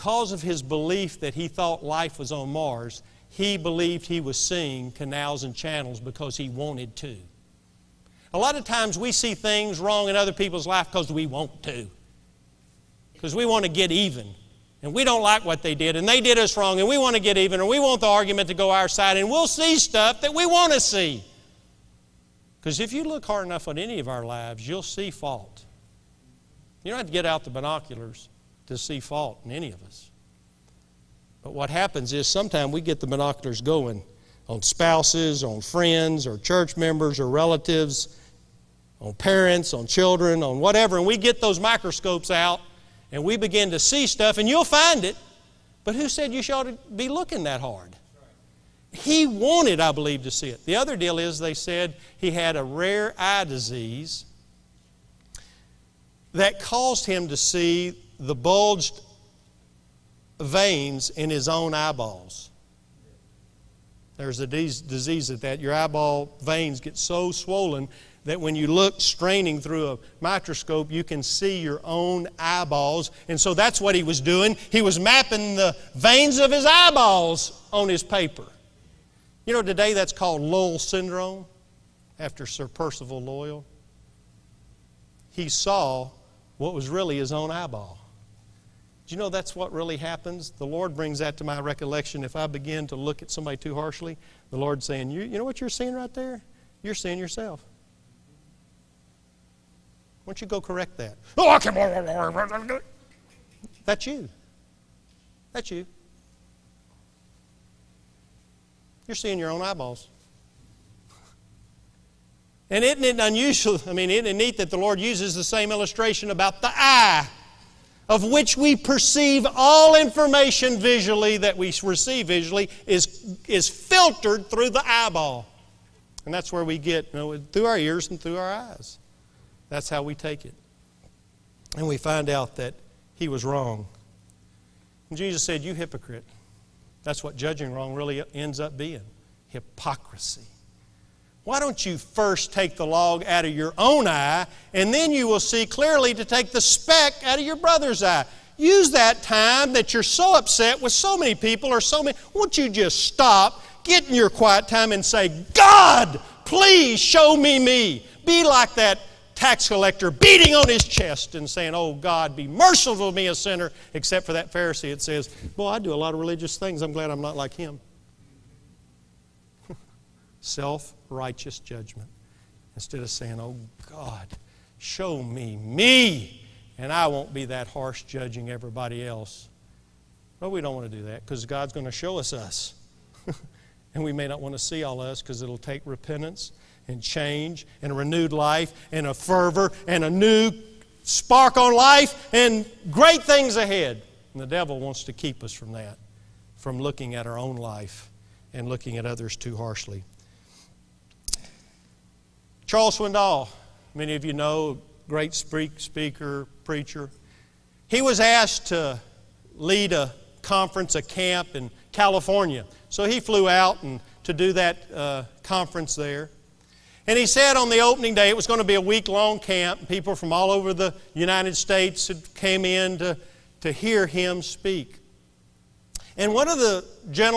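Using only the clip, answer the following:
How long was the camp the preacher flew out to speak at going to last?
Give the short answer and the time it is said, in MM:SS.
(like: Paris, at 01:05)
A week, at 03:38.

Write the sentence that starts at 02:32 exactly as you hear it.
Won't you just stop, get in your quiet time, and say, God, please show me me.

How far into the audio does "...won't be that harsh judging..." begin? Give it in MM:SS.
02:57.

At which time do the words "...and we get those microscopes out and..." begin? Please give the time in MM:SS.
00:40.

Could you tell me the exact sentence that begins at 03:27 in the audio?
He was asked to lead a conference, a camp in California.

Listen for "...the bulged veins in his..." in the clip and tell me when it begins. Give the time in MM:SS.
00:58.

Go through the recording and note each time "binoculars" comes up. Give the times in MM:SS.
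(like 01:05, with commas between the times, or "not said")
00:27, 00:33.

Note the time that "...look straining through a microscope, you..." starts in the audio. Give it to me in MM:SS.
01:08.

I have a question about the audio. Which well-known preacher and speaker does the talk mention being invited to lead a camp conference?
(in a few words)
Charles Swindoll.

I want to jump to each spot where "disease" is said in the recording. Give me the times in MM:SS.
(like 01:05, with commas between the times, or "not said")
00:53, 01:04.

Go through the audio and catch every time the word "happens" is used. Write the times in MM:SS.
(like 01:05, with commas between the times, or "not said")
00:31, 01:29.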